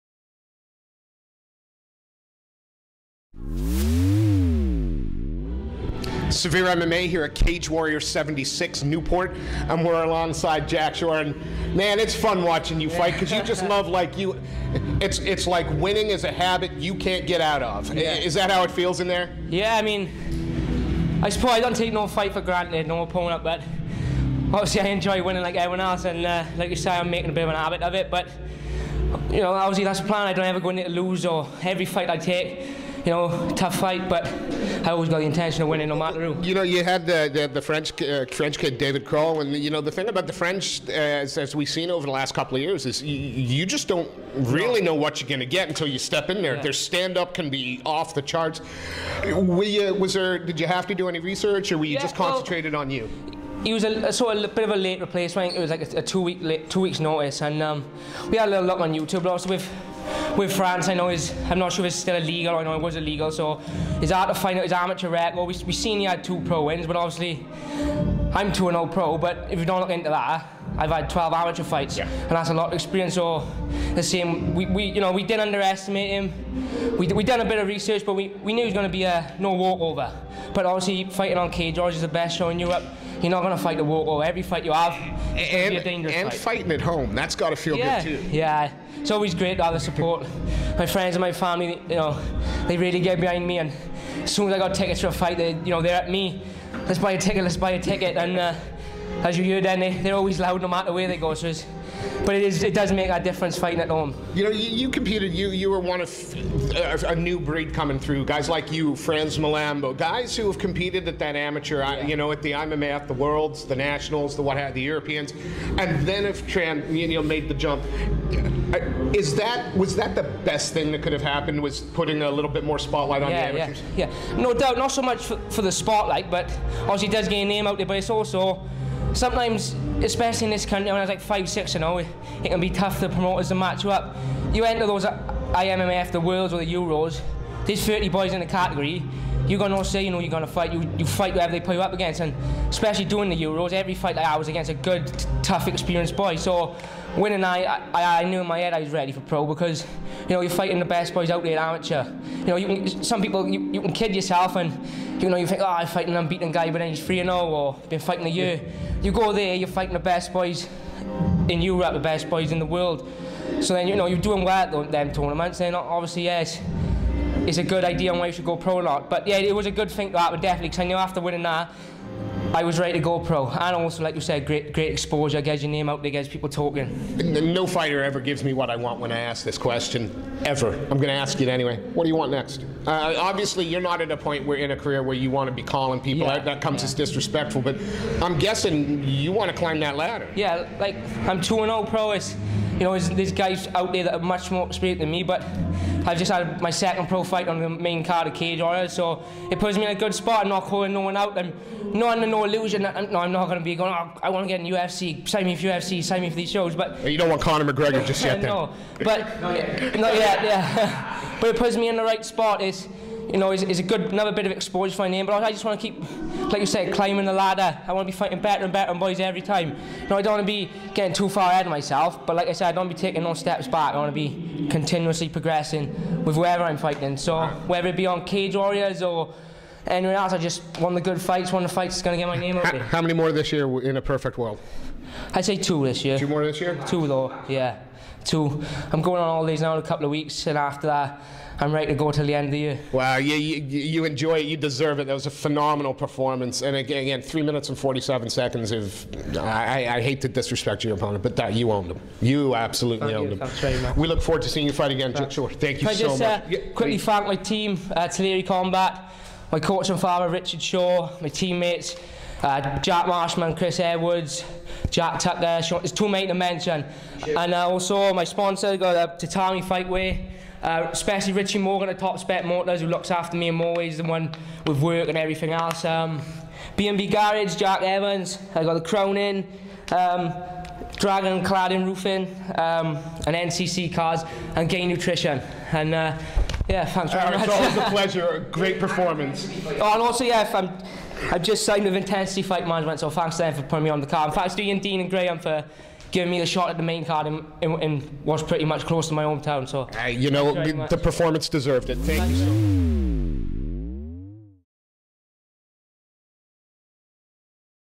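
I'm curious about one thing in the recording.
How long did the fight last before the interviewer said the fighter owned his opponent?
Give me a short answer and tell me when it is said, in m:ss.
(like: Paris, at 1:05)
3 minutes 47 seconds, at 4:07.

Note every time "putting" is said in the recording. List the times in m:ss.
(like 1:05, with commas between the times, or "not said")
2:01, 4:53.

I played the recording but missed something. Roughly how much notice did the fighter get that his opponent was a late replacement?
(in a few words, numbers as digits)
Two weeks.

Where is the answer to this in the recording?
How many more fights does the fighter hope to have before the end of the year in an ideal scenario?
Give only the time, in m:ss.
3:56.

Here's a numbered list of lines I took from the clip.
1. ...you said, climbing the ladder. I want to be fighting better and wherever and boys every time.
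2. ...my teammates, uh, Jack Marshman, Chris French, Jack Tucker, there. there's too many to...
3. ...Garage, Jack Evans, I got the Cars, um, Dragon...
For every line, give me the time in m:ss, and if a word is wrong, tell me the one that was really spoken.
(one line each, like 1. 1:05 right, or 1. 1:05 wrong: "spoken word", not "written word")
1. 3:36 wrong: "better", not "wherever"
2. 4:21 wrong: "Edwards", not "French"
3. 4:37 wrong: "Cronin", not "Cars".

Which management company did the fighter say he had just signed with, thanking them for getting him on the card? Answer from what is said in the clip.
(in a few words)
Intensity Fight Management.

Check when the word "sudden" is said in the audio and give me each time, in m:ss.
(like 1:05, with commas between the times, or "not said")
not said.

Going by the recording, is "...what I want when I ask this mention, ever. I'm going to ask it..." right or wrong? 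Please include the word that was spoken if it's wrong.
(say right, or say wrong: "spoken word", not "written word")
wrong: "question", not "mention".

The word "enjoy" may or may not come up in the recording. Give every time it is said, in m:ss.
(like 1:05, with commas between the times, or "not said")
0:24, 4:04.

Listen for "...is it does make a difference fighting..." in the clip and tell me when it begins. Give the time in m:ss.
1:42.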